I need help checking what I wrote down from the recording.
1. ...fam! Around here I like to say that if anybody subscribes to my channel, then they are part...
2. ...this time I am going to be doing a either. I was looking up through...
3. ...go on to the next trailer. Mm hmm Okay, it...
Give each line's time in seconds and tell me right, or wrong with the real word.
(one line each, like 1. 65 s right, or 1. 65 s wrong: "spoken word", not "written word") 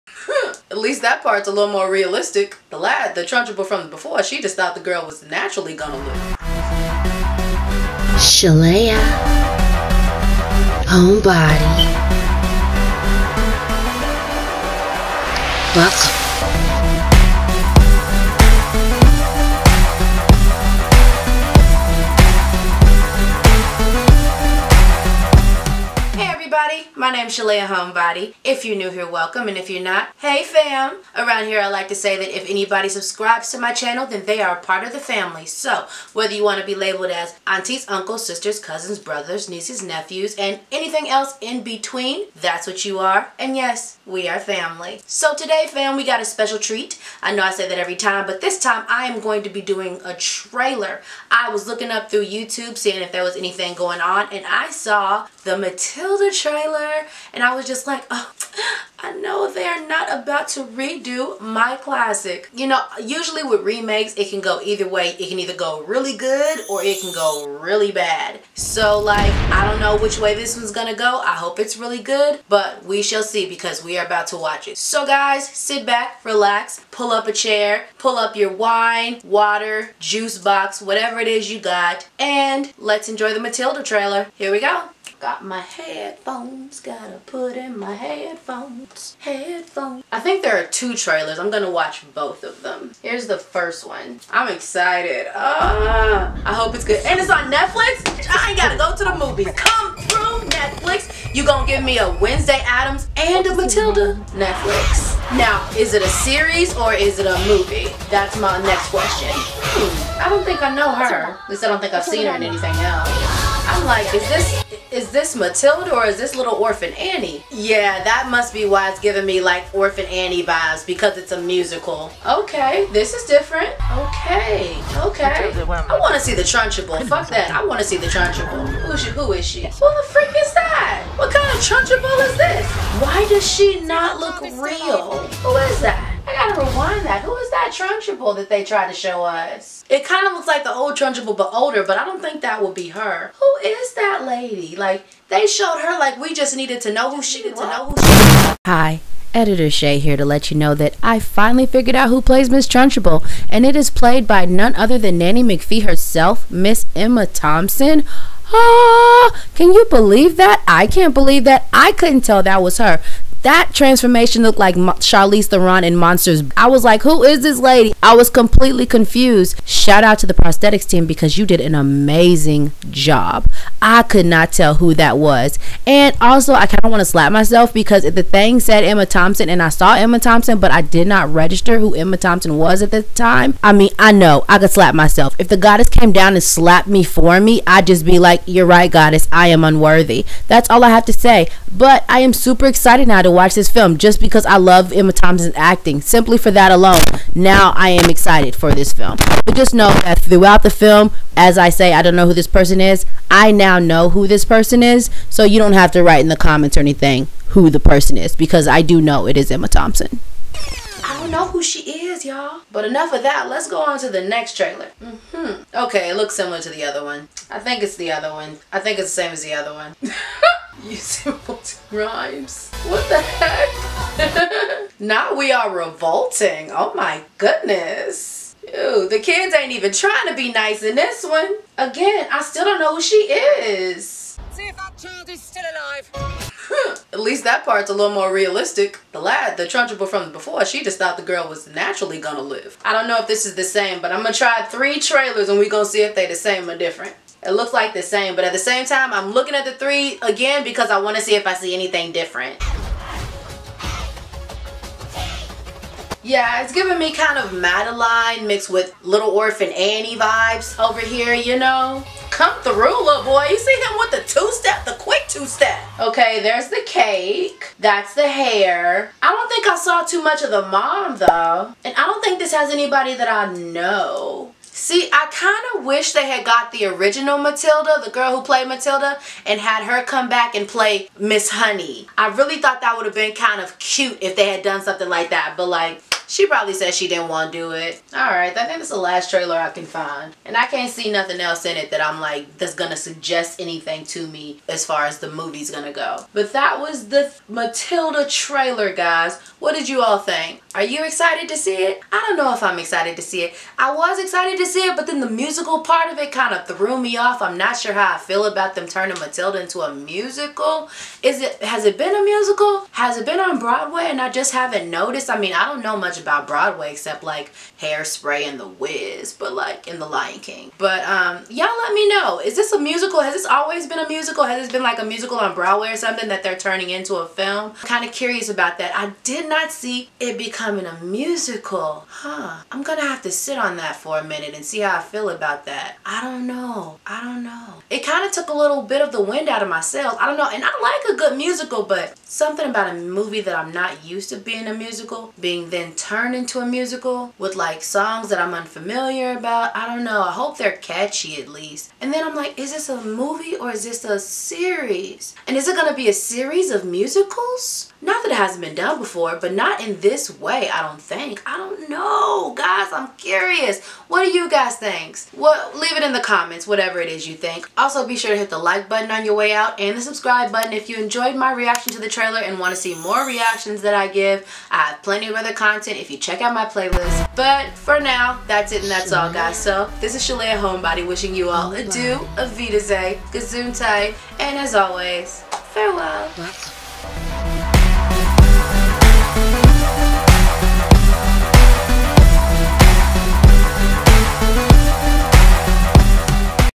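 1. 30 s right
2. 48 s wrong: "trailer", not "either"
3. 213 s right.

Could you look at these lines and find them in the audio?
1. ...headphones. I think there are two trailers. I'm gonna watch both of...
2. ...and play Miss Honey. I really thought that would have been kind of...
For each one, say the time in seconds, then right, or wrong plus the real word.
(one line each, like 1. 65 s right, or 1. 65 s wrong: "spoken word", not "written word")
1. 89 s right
2. 280 s right.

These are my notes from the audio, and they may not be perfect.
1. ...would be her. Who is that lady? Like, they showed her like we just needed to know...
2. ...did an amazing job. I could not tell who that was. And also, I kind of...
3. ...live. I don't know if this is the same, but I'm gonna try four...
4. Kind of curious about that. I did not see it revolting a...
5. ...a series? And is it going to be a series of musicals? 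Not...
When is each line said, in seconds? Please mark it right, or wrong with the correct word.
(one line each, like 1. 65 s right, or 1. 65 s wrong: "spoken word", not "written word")
1. 142 s right
2. 171 s right
3. 242 s wrong: "three", not "four"
4. 327 s wrong: "becoming", not "revolting"
5. 354 s right.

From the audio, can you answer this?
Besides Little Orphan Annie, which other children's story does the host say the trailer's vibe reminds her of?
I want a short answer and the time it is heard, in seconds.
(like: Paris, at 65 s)
Madeline, at 257 s.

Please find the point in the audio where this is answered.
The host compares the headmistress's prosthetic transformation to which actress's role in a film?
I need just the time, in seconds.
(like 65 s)
164 s.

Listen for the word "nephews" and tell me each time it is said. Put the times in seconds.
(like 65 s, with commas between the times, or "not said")
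39 s.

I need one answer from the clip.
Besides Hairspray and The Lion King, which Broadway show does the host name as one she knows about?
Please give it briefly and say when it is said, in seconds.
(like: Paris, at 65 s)
The Wiz, at 318 s.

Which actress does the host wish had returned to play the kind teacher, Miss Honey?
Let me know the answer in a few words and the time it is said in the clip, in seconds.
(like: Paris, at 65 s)
The original Matilda, at 276 s.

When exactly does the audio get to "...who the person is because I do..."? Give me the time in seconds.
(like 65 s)
207 s.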